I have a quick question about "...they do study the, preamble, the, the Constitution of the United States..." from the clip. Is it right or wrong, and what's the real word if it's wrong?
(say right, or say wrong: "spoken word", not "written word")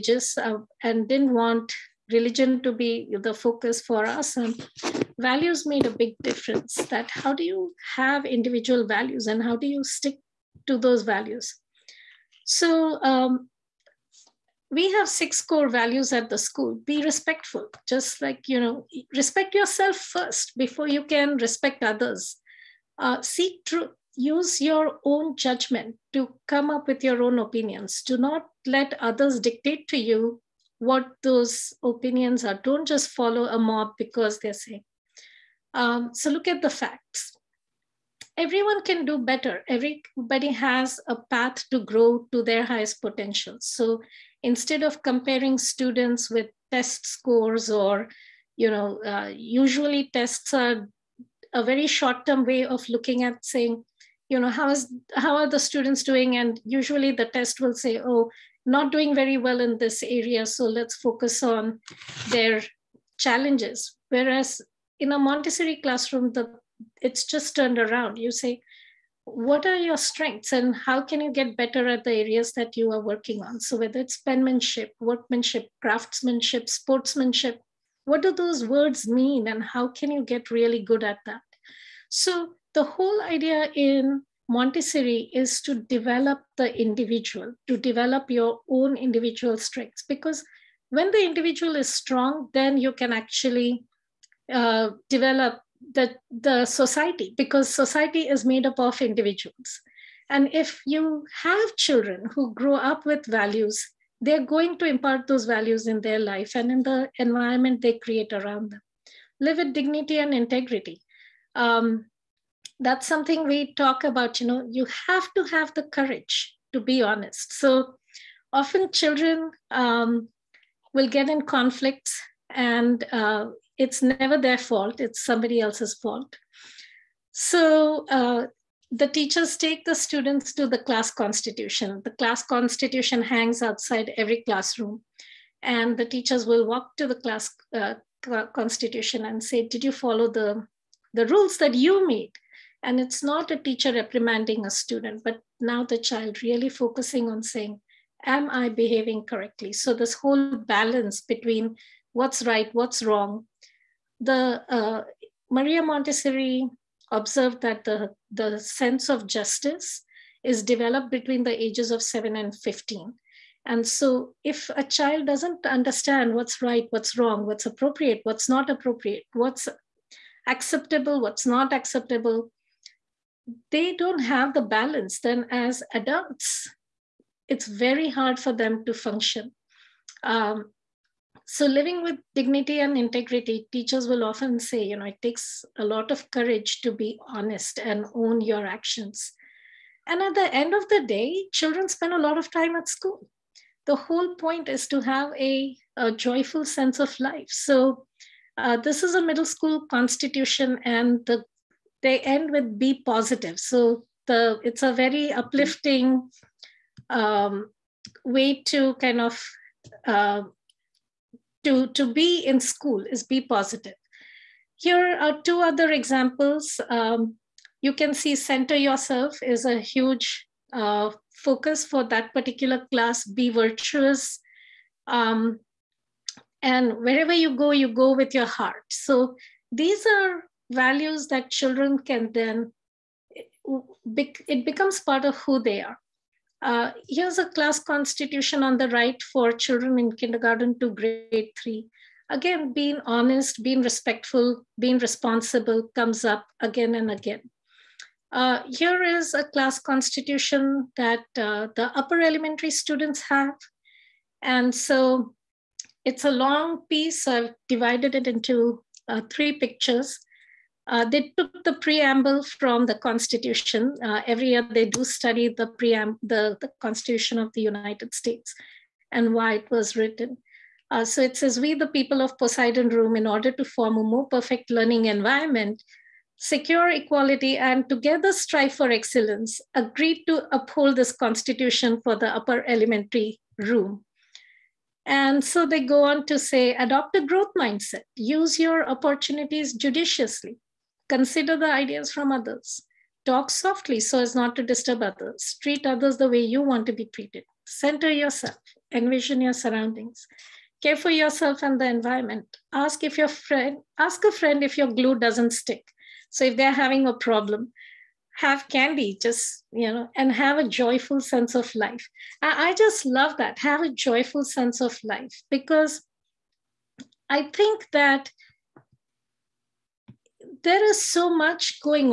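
right.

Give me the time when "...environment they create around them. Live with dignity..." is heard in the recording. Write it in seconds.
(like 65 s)
107 s.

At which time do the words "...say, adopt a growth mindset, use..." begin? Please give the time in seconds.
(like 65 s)
286 s.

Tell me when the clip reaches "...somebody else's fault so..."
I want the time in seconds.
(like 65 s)
125 s.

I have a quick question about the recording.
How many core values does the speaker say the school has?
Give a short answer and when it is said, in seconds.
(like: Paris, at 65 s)
6, at 15 s.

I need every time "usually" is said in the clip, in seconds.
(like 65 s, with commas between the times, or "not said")
49 s, 56 s.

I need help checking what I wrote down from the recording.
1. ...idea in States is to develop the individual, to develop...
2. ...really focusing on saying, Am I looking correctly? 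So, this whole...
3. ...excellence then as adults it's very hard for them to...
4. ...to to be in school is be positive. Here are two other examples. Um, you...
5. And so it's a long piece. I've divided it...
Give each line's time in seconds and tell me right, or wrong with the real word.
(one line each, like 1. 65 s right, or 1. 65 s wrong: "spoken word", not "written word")
1. 83 s wrong: "Montessori", not "States"
2. 146 s wrong: "behaving", not "looking"
3. 174 s wrong: "balance", not "excellence"
4. 211 s right
5. 254 s right.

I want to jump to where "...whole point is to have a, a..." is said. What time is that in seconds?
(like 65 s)
193 s.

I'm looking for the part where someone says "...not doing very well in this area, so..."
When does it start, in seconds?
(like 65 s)
58 s.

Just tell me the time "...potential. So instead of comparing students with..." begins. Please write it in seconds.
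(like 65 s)
43 s.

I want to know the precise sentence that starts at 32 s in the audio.
Don't just follow a mob because they're saying.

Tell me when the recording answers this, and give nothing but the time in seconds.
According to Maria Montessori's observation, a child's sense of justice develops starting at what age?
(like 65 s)
162 s.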